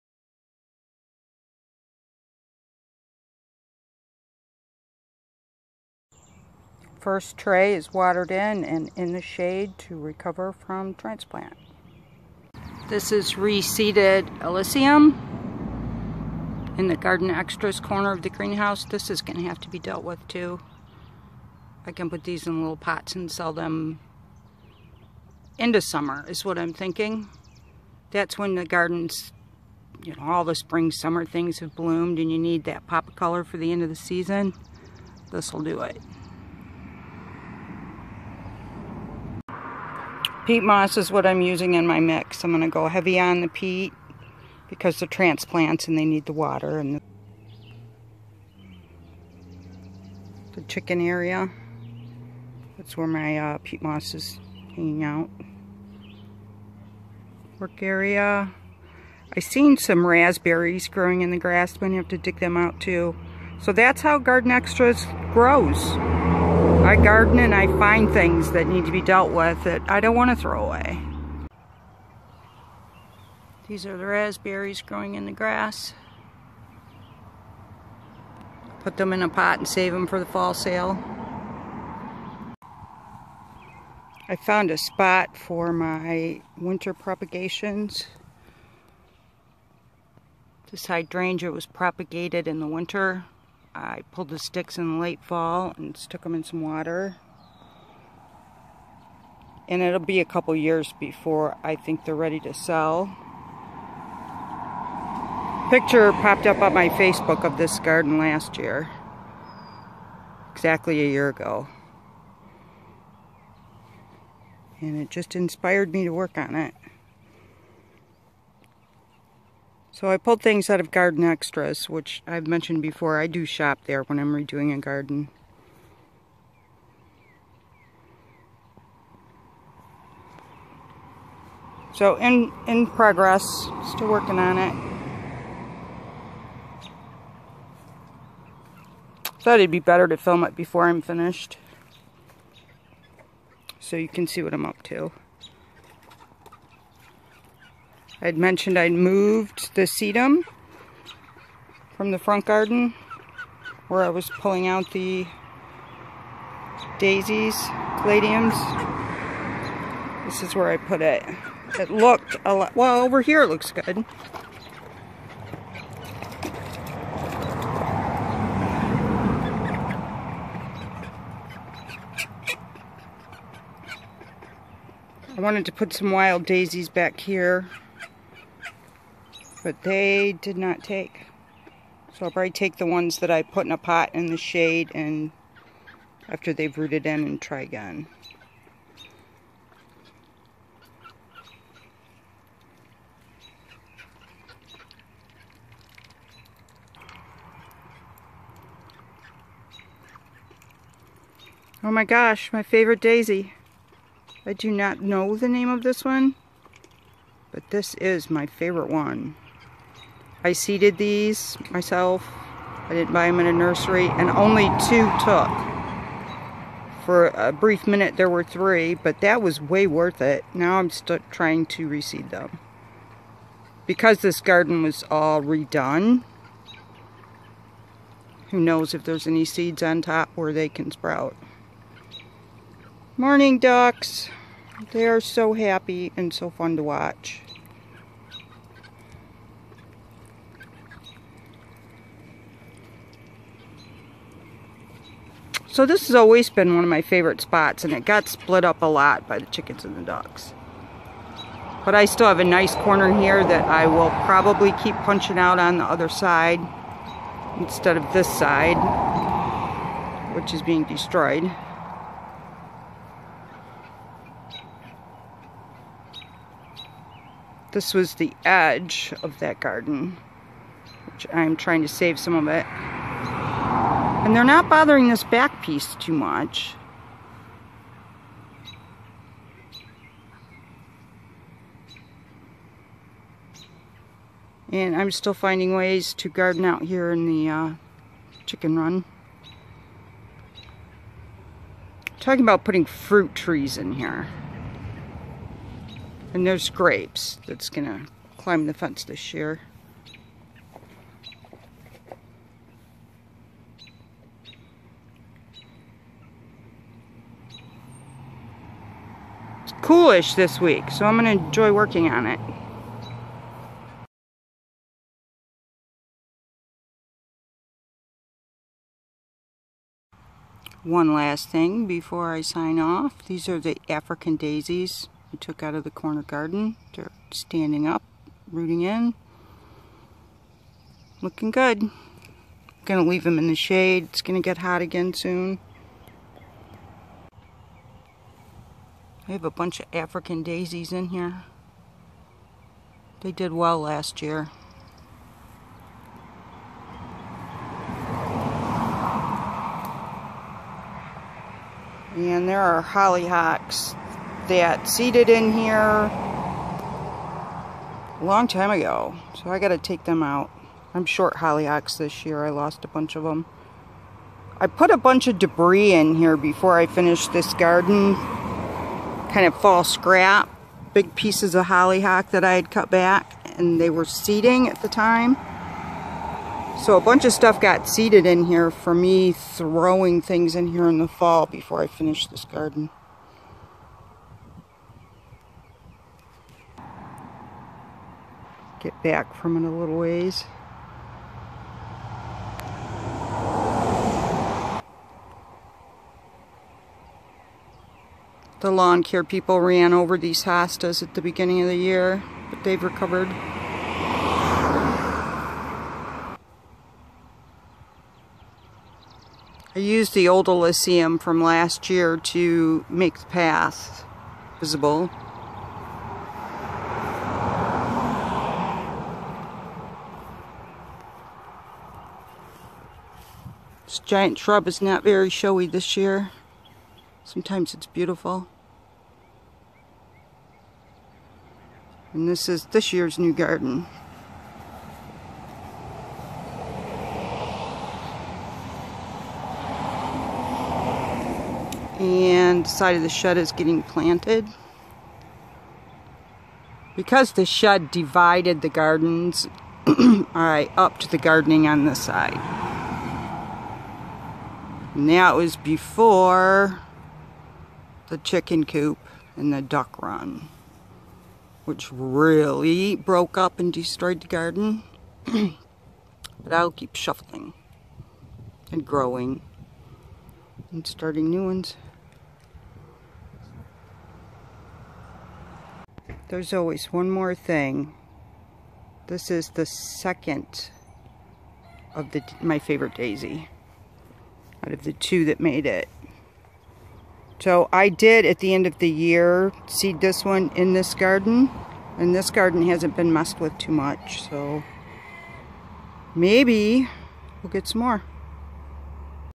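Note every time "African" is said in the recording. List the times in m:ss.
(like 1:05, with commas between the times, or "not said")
5:23, 5:39.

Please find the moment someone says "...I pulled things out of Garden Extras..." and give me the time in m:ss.
2:00.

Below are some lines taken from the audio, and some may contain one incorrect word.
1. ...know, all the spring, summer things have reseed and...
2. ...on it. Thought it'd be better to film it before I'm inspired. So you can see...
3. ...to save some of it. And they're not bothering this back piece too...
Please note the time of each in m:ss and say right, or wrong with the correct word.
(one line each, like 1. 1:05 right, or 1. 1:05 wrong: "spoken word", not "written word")
1. 0:30 wrong: "bloomed", not "reseed"
2. 2:14 wrong: "finished", not "inspired"
3. 4:31 right.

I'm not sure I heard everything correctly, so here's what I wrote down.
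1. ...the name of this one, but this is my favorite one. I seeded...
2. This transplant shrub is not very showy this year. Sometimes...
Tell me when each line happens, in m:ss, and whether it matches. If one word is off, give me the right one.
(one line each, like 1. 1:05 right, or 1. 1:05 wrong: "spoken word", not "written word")
1. 3:25 right
2. 7:03 wrong: "giant", not "transplant".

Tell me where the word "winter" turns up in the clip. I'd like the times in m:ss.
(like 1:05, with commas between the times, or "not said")
1:26, 1:32.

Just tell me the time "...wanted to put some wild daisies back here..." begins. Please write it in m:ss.
2:55.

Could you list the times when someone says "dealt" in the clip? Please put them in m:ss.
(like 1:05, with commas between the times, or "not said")
0:19, 1:09.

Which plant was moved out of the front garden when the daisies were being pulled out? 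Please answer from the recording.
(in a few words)
Sedum.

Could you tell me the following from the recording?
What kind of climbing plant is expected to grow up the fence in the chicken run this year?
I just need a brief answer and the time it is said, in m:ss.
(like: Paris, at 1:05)
Grapes, at 4:56.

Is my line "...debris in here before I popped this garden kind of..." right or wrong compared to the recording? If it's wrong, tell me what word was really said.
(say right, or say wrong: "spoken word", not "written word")
wrong: "finished", not "popped".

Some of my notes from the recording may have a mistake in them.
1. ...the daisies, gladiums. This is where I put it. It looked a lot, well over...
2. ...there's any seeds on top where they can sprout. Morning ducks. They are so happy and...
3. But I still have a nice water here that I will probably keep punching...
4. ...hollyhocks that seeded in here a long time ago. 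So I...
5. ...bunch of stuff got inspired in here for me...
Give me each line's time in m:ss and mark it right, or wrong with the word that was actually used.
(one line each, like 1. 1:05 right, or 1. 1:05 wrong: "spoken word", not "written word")
1. 2:34 right
2. 3:49 right
3. 4:11 wrong: "corner", not "water"
4. 5:52 right
5. 6:17 wrong: "seeded", not "inspired".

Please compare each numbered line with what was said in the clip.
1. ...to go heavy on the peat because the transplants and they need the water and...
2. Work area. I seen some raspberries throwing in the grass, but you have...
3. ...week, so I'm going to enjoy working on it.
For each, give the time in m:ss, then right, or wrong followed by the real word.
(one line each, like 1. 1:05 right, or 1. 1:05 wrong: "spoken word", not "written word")
1. 0:42 right
2. 0:57 wrong: "growing", not "throwing"
3. 5:10 right.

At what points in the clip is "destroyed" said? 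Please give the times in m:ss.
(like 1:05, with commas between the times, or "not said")
4:20, 7:43.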